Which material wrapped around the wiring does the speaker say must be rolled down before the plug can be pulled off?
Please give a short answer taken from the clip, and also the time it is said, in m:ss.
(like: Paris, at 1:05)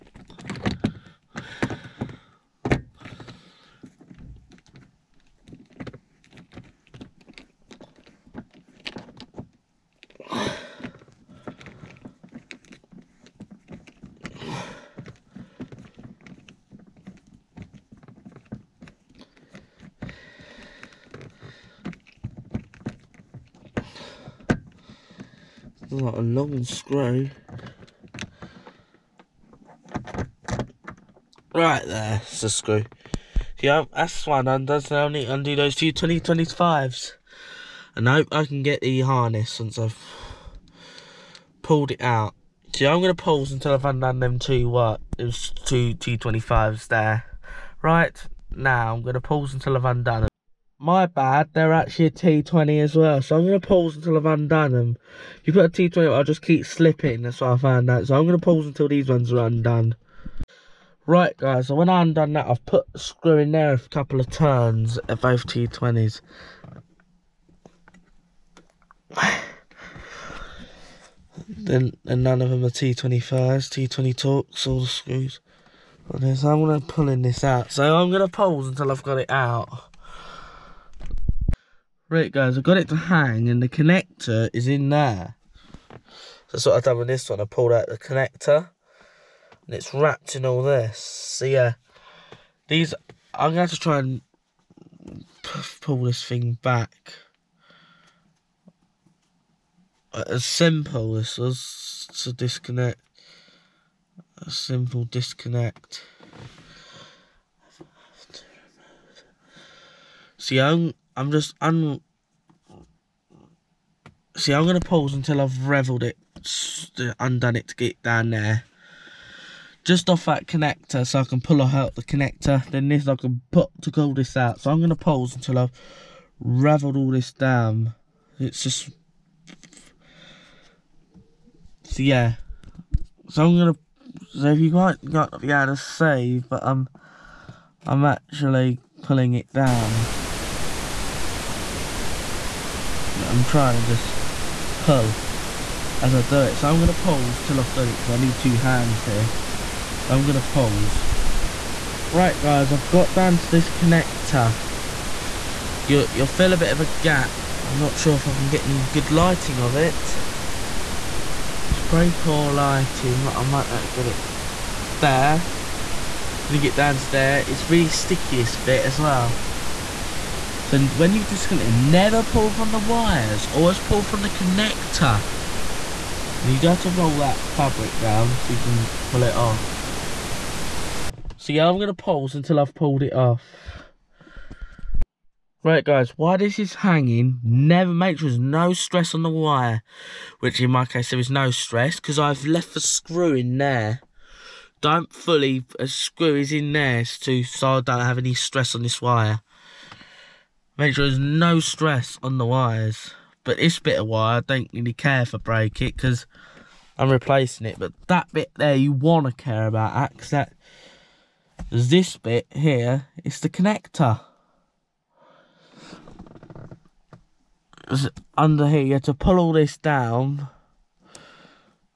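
fabric, at 2:57.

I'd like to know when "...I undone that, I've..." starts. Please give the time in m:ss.
1:01.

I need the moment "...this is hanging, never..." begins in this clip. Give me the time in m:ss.
3:06.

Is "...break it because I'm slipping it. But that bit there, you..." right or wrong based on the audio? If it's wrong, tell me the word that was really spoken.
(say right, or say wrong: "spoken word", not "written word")
wrong: "replacing", not "slipping".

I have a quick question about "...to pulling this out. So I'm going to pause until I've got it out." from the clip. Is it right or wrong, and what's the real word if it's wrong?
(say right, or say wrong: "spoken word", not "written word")
right.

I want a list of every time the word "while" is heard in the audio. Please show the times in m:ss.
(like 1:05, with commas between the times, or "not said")
3:06.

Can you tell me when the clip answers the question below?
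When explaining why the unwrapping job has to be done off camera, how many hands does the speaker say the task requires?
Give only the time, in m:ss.
2:28.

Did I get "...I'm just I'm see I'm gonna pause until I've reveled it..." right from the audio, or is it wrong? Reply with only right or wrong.
right.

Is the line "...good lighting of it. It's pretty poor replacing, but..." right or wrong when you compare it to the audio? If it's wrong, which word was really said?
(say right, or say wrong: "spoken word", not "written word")
wrong: "lighting", not "replacing".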